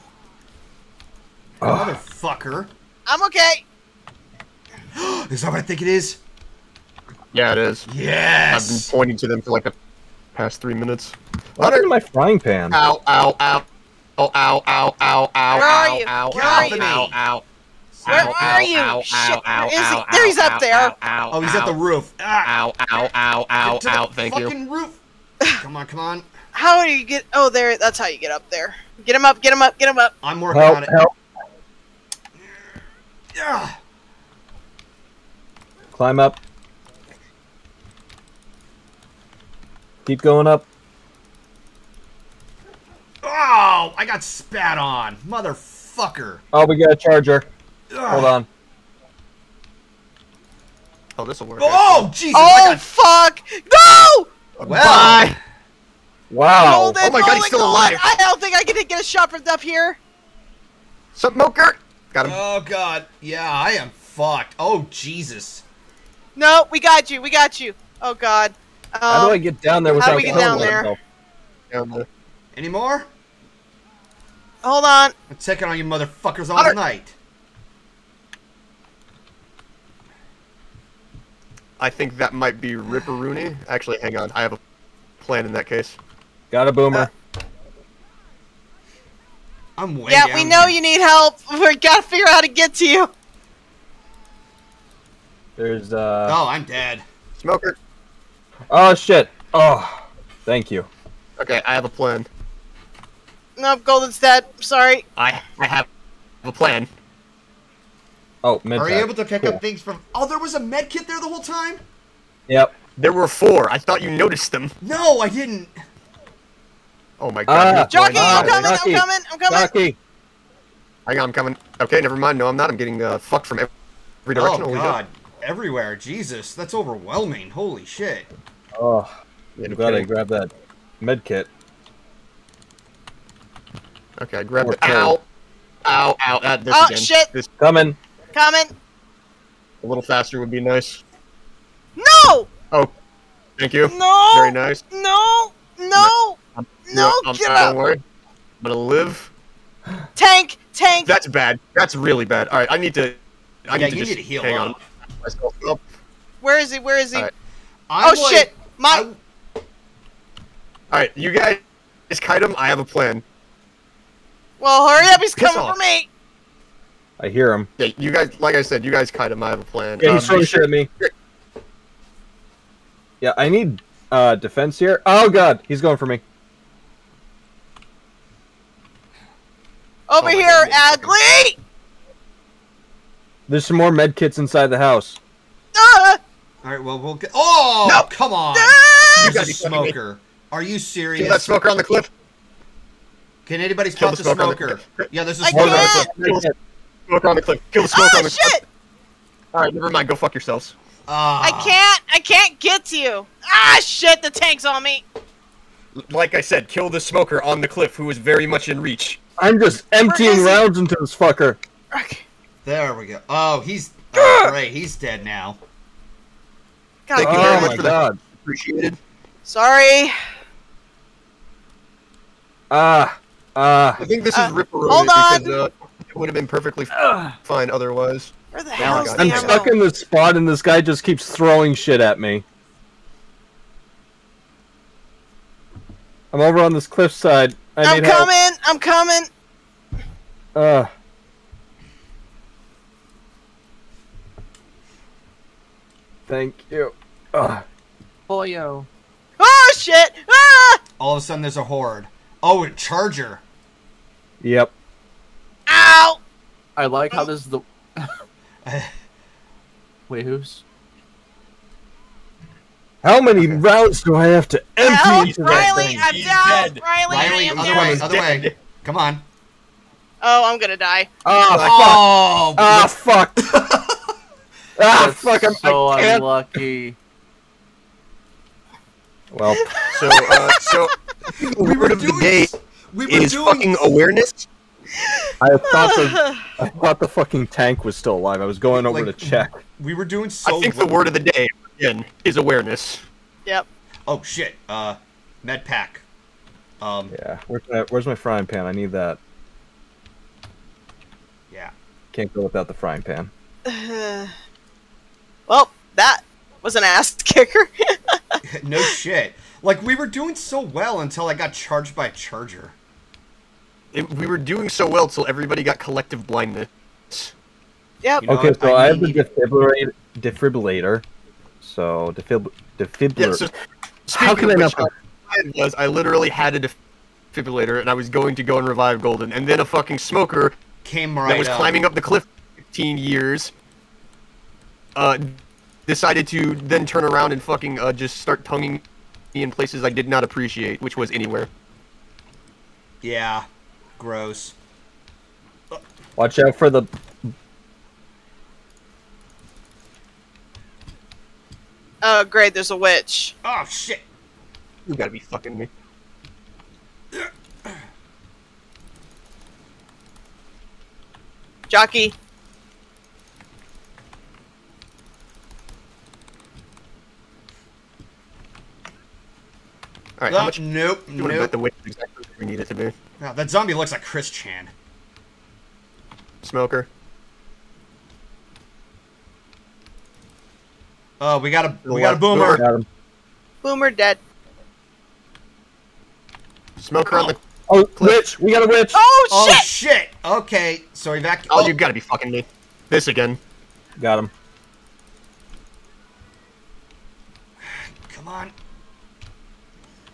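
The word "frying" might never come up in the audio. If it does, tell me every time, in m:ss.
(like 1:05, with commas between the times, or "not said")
0:11, 4:58, 5:02.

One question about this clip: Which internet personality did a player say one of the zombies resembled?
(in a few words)
Chris Chan.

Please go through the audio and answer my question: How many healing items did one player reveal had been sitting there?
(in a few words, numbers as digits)
4.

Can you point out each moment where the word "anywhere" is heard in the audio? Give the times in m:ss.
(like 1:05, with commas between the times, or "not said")
5:41.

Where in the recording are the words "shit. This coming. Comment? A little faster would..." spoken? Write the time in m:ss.
2:16.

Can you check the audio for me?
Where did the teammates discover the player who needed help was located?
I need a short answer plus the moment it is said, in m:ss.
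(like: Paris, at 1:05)
the roof, at 0:21.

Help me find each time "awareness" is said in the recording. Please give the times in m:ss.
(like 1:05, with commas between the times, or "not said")
4:43, 4:52.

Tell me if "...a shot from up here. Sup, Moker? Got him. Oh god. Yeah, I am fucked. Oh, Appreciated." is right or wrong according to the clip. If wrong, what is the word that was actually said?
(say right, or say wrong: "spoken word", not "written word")
wrong: "Jesus", not "Appreciated".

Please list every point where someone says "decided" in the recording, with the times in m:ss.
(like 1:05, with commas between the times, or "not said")
5:35.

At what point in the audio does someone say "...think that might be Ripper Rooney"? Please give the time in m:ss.
1:21.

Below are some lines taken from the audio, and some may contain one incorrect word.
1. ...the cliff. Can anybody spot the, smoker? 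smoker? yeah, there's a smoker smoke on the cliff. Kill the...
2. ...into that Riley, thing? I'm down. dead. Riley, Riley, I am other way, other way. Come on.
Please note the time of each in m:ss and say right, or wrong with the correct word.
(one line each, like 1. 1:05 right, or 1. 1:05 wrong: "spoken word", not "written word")
1. 3:11 right
2. 4:25 right.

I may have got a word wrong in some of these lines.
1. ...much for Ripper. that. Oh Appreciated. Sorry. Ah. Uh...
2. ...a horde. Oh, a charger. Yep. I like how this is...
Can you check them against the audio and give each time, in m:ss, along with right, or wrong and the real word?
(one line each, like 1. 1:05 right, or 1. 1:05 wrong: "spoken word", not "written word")
1. 3:37 wrong: "God", not "Ripper"
2. 4:11 right.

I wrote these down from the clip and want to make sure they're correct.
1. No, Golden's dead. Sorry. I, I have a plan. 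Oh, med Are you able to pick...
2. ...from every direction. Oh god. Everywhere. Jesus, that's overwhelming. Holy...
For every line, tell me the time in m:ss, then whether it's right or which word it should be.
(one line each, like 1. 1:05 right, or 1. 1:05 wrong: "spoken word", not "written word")
1. 1:43 right
2. 2:03 right.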